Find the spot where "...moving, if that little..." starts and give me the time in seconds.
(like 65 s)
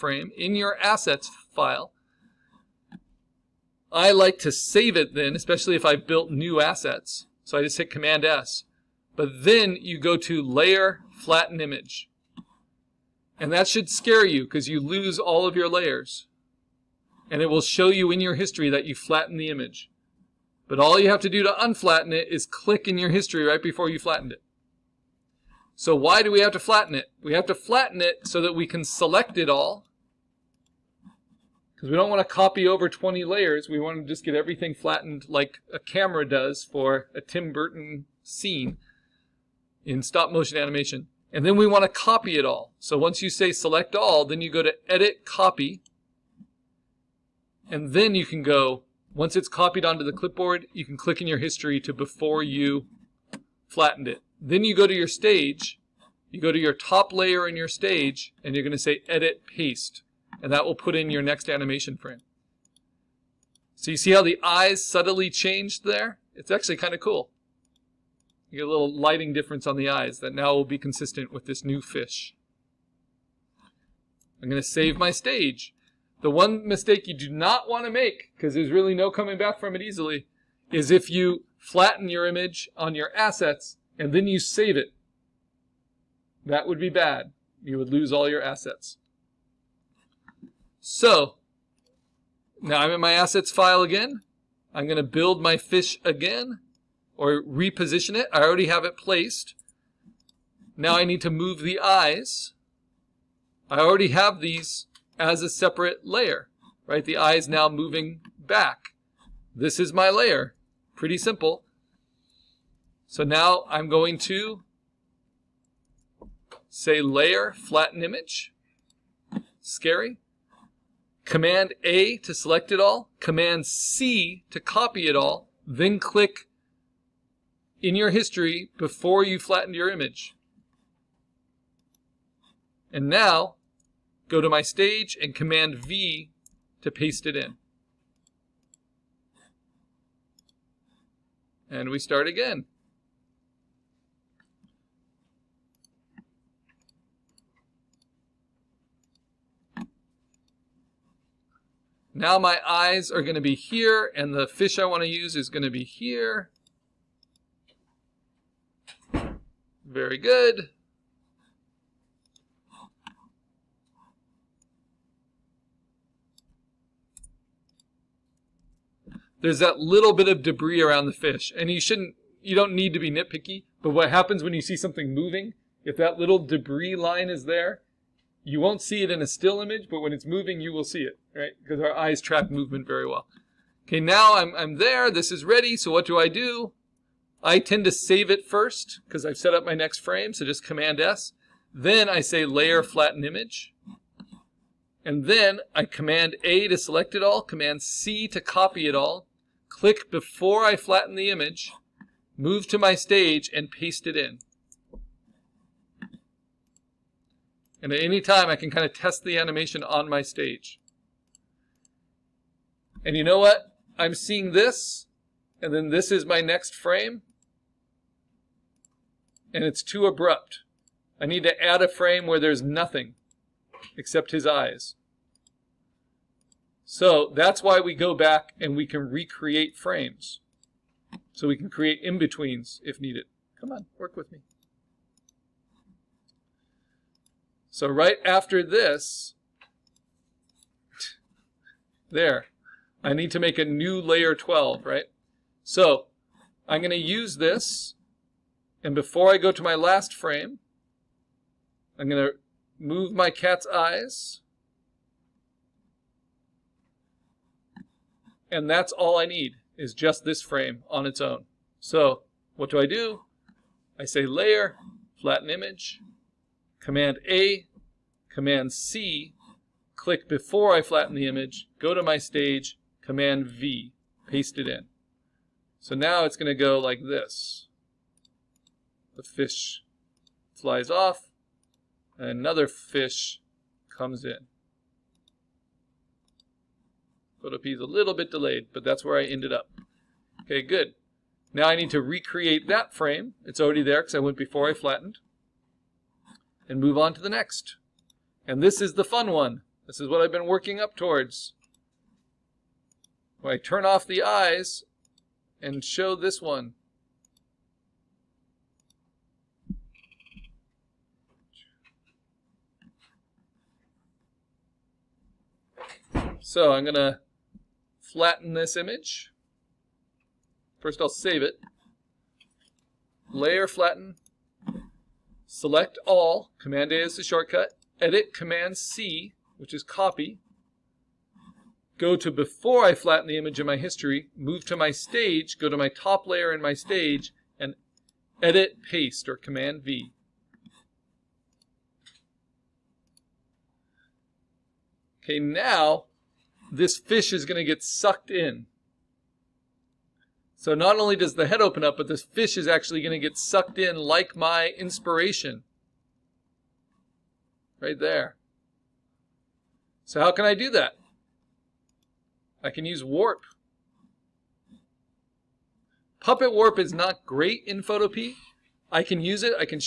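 175 s.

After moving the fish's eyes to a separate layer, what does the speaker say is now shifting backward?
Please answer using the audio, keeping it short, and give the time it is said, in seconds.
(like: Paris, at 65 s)
The eye, at 107 s.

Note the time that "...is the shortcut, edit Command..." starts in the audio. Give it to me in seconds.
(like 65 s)
327 s.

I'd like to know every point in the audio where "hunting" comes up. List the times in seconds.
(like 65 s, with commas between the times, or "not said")
not said.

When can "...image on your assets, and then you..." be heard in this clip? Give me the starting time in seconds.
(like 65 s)
82 s.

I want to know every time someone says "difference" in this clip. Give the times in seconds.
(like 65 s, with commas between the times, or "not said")
69 s.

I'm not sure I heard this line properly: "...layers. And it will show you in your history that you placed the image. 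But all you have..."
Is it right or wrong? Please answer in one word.
wrong.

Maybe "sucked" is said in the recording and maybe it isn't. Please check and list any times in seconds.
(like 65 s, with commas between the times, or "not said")
347 s, 353 s.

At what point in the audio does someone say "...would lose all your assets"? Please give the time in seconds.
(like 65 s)
87 s.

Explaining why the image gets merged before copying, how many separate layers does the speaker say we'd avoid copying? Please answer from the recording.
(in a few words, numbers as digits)
20.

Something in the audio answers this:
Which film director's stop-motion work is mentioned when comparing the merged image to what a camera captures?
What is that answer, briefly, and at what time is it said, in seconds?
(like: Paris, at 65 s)
Tim Burton, at 37 s.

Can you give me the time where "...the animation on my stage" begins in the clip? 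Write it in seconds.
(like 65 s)
209 s.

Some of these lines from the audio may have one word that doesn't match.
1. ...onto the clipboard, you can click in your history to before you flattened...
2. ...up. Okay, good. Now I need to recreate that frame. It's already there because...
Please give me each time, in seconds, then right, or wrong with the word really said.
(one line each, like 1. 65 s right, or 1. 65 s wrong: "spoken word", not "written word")
1. 49 s right
2. 289 s right.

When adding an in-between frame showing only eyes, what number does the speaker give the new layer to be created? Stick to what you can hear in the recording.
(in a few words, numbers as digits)
12.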